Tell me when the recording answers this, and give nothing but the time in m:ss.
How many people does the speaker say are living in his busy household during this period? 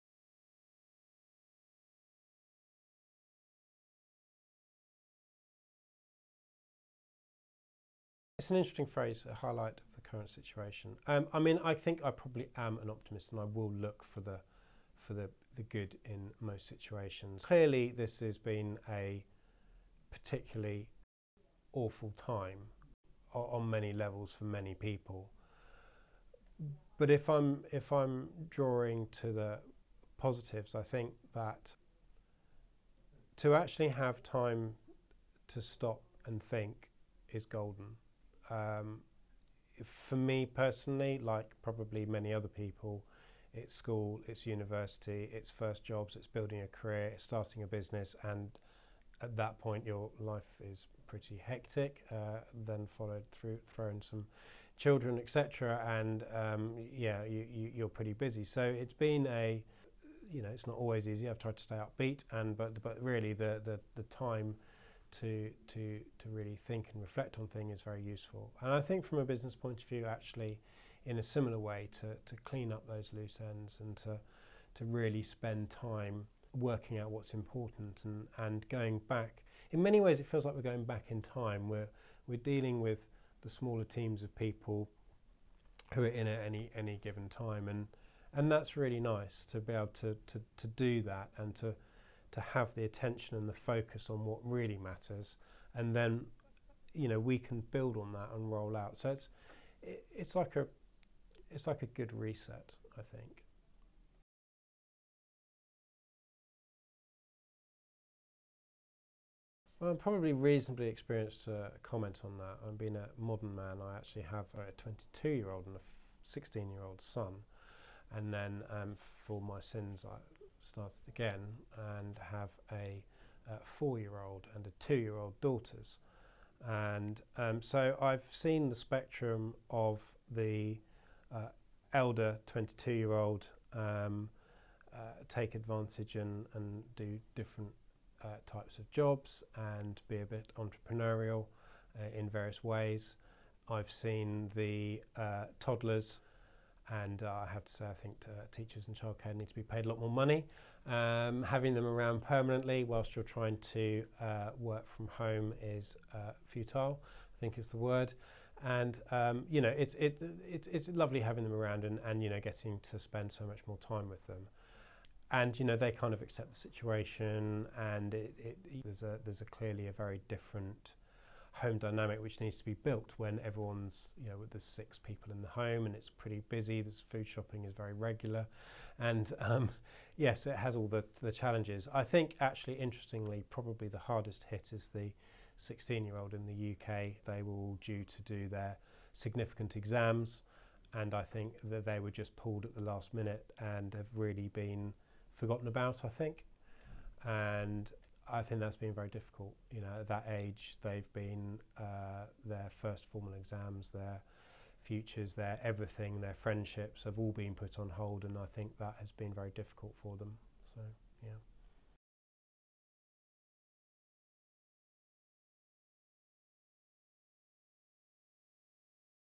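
2:54.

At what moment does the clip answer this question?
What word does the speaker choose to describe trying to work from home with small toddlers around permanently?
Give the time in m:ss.
2:36.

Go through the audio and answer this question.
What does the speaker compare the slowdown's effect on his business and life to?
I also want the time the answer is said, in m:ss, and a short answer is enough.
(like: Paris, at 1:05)
a good reset, at 1:41.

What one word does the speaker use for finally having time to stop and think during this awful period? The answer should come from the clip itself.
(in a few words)
golden.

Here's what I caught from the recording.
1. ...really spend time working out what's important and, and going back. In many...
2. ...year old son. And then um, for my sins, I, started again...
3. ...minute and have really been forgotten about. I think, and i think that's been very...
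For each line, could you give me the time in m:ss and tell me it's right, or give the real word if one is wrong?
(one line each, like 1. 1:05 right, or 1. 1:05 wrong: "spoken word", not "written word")
1. 1:14 right
2. 1:56 right
3. 3:13 right.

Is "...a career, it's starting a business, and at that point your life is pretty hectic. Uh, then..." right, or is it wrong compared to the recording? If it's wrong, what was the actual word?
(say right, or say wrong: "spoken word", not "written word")
right.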